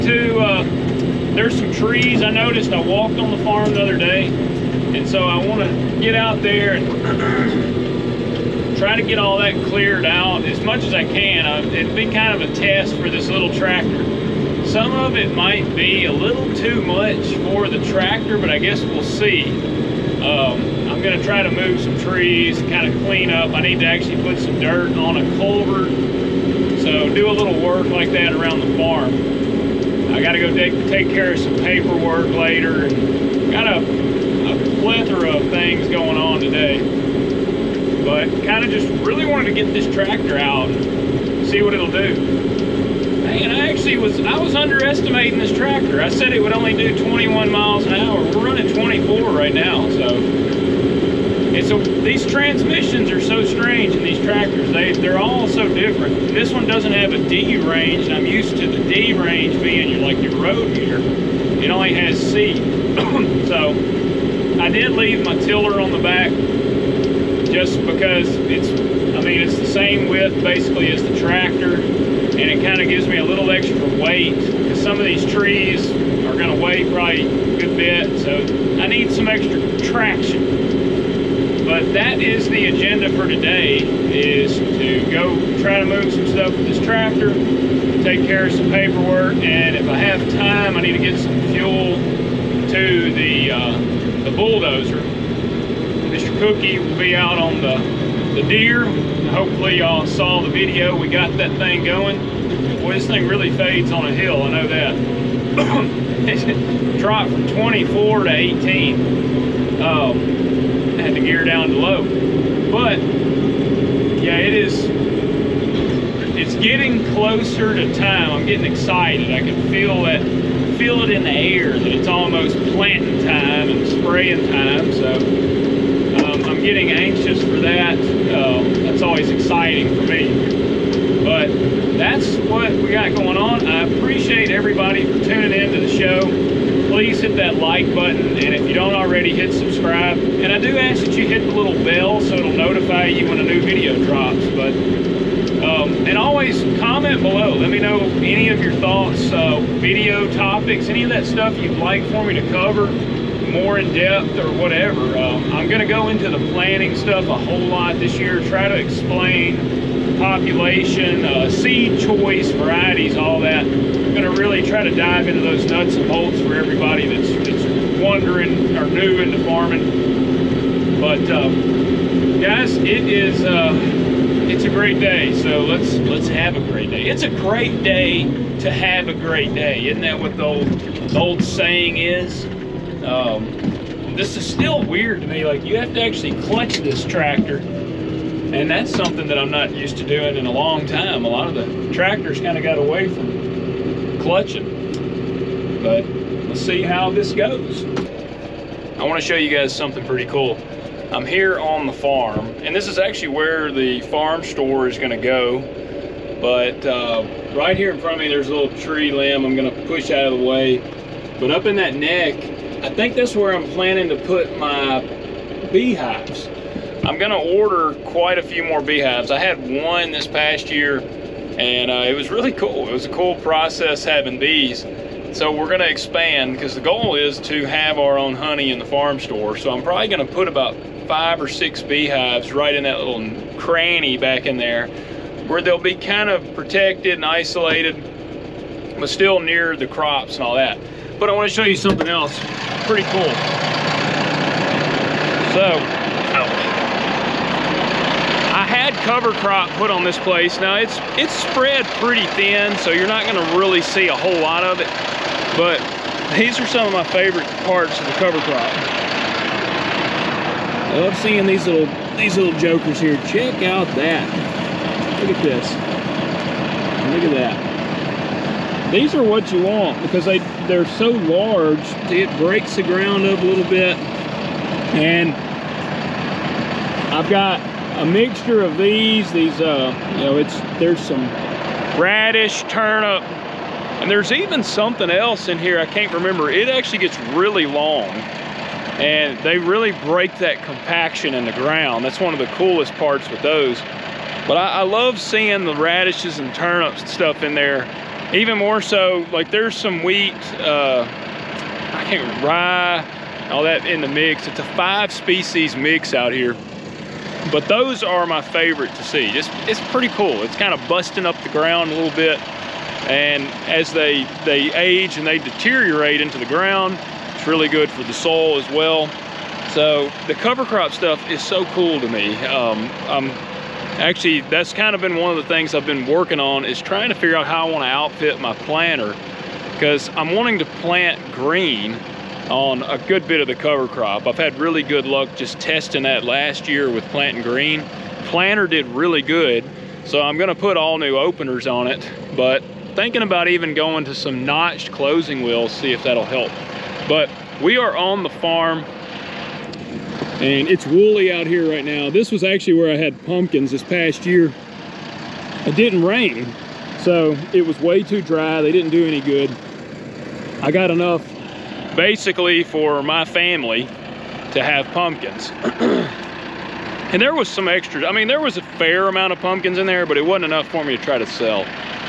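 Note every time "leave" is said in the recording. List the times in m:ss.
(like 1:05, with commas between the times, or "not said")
1:04.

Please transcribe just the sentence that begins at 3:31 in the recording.
But up in that neck, I think that's where I'm planning to put my beehives.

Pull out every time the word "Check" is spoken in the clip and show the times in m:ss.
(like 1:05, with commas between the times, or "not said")
4:23.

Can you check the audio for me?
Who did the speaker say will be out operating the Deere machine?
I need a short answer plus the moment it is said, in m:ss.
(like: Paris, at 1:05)
Mr. Cookie, at 1:34.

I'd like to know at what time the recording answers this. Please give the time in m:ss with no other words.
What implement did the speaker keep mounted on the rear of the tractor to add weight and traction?
1:05.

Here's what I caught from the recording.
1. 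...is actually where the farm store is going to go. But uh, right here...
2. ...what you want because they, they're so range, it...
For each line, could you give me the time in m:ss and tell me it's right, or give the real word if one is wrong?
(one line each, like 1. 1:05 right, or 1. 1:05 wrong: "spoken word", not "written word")
1. 3:22 right
2. 4:29 wrong: "large", not "range".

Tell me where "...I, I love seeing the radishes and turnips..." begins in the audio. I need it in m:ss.
4:54.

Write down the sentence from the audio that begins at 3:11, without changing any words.
A lot of the tractors kind of got away from clutching, but let's see how this goes.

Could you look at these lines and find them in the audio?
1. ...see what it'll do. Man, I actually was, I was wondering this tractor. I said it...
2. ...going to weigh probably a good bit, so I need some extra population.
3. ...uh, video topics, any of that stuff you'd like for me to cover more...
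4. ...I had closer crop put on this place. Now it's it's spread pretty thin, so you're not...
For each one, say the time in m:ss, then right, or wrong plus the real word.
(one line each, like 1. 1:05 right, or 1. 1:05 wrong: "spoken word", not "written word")
1. 0:41 wrong: "underestimating", not "wondering"
2. 1:16 wrong: "traction", not "population"
3. 2:29 right
4. 4:08 wrong: "cover", not "closer".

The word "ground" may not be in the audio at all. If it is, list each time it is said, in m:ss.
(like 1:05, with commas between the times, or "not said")
4:32, 4:51, 5:11, 5:16.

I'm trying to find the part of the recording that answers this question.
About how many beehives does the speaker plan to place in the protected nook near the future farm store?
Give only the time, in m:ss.
3:51.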